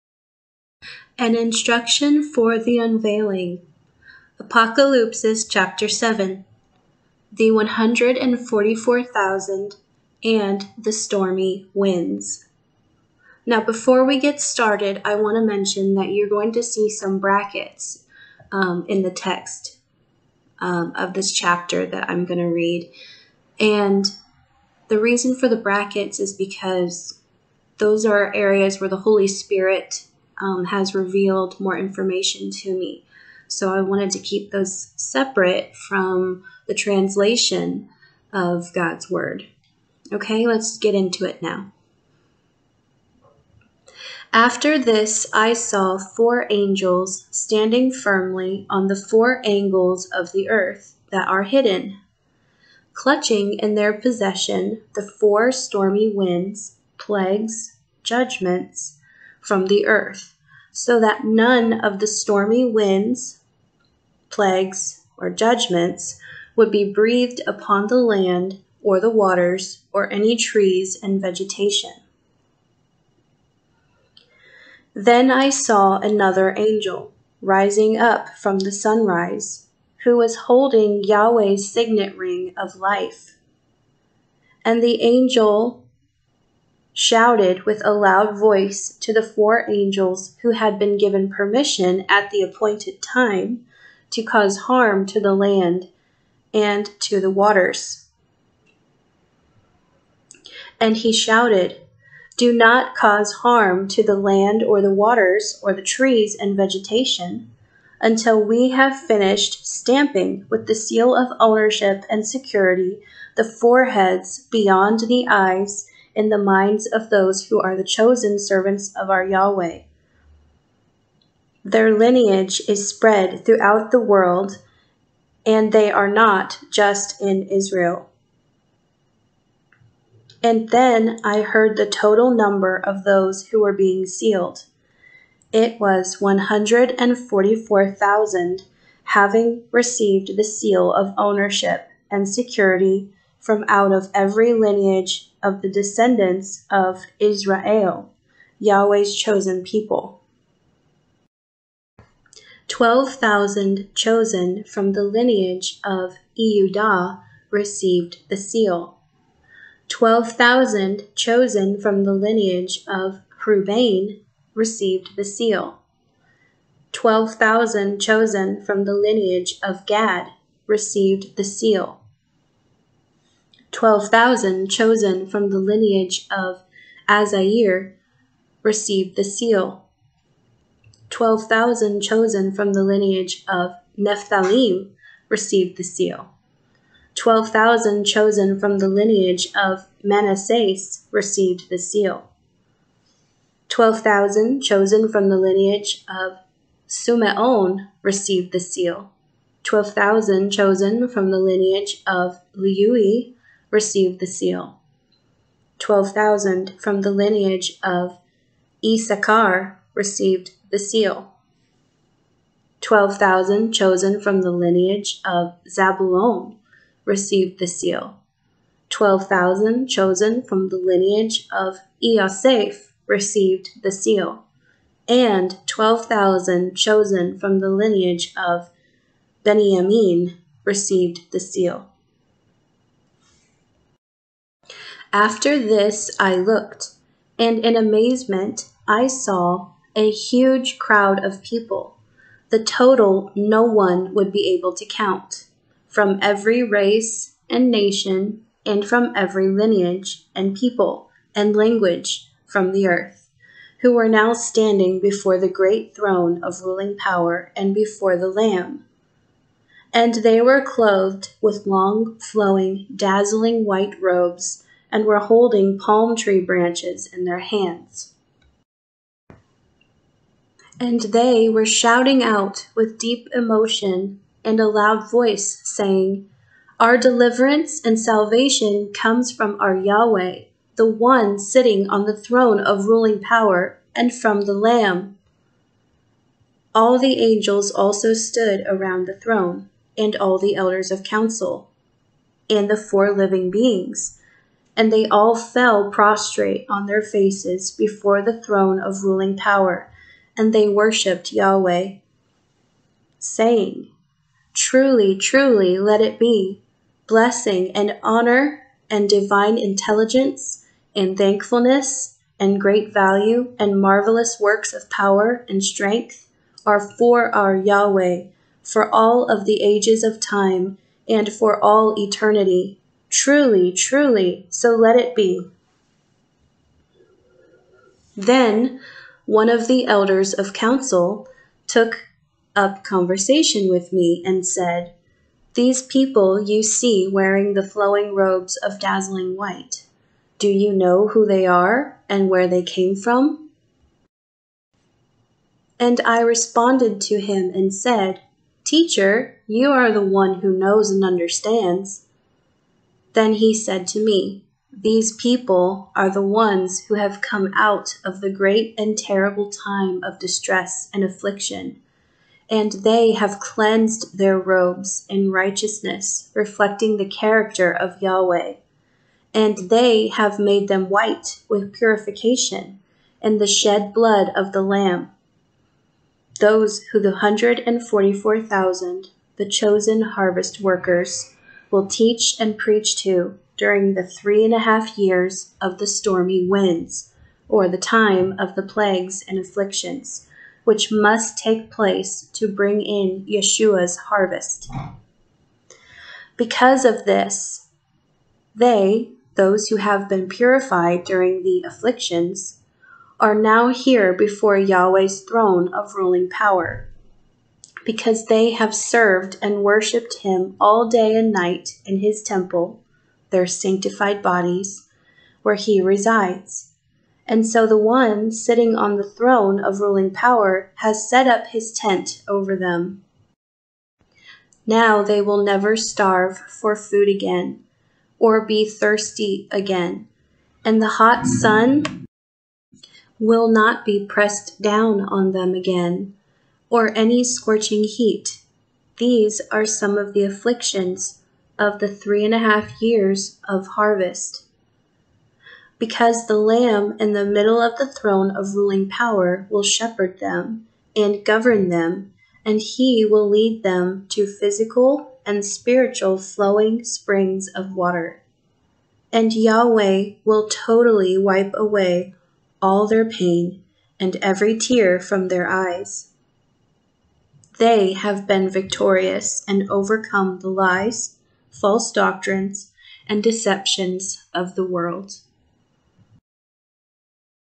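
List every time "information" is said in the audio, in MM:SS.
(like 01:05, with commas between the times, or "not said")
00:31.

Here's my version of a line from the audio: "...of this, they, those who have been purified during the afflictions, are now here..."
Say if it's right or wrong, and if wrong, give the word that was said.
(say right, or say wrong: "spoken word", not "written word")
right.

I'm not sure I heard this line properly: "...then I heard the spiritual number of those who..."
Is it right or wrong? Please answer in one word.
wrong.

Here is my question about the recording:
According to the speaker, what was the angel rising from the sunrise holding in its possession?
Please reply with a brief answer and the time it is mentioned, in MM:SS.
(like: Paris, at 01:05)
Yahweh's signet ring of life, at 01:21.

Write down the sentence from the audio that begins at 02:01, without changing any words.
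Their lineage is spread throughout the world, and they are not just in Israel.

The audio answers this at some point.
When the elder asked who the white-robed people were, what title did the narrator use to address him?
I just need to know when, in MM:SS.
05:48.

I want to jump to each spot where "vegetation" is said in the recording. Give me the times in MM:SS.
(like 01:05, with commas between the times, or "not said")
01:11, 01:46.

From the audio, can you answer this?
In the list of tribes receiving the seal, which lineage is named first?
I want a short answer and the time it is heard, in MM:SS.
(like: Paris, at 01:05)
Eudah, at 02:36.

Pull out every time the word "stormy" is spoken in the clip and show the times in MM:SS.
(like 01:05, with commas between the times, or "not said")
00:10, 00:55, 01:02, 06:25.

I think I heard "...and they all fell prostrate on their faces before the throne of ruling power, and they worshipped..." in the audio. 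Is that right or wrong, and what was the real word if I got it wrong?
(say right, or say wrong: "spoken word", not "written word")
right.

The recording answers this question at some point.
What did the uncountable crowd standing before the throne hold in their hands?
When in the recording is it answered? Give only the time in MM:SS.
04:25.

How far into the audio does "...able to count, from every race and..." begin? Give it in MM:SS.
04:04.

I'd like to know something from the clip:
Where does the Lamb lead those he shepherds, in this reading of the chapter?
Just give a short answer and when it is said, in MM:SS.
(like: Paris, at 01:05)
Flowing springs of water, at 07:36.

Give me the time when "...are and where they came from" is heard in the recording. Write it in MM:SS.
05:41.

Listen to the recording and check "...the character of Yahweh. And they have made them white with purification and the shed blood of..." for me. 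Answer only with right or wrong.
right.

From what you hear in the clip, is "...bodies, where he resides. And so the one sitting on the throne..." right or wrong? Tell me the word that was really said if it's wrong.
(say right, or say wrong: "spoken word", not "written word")
right.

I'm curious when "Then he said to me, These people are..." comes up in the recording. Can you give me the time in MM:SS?
05:53.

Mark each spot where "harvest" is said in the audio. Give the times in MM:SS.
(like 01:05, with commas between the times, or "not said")
06:20, 06:34, 07:23.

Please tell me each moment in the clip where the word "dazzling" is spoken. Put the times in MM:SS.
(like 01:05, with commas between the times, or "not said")
04:22, 05:38.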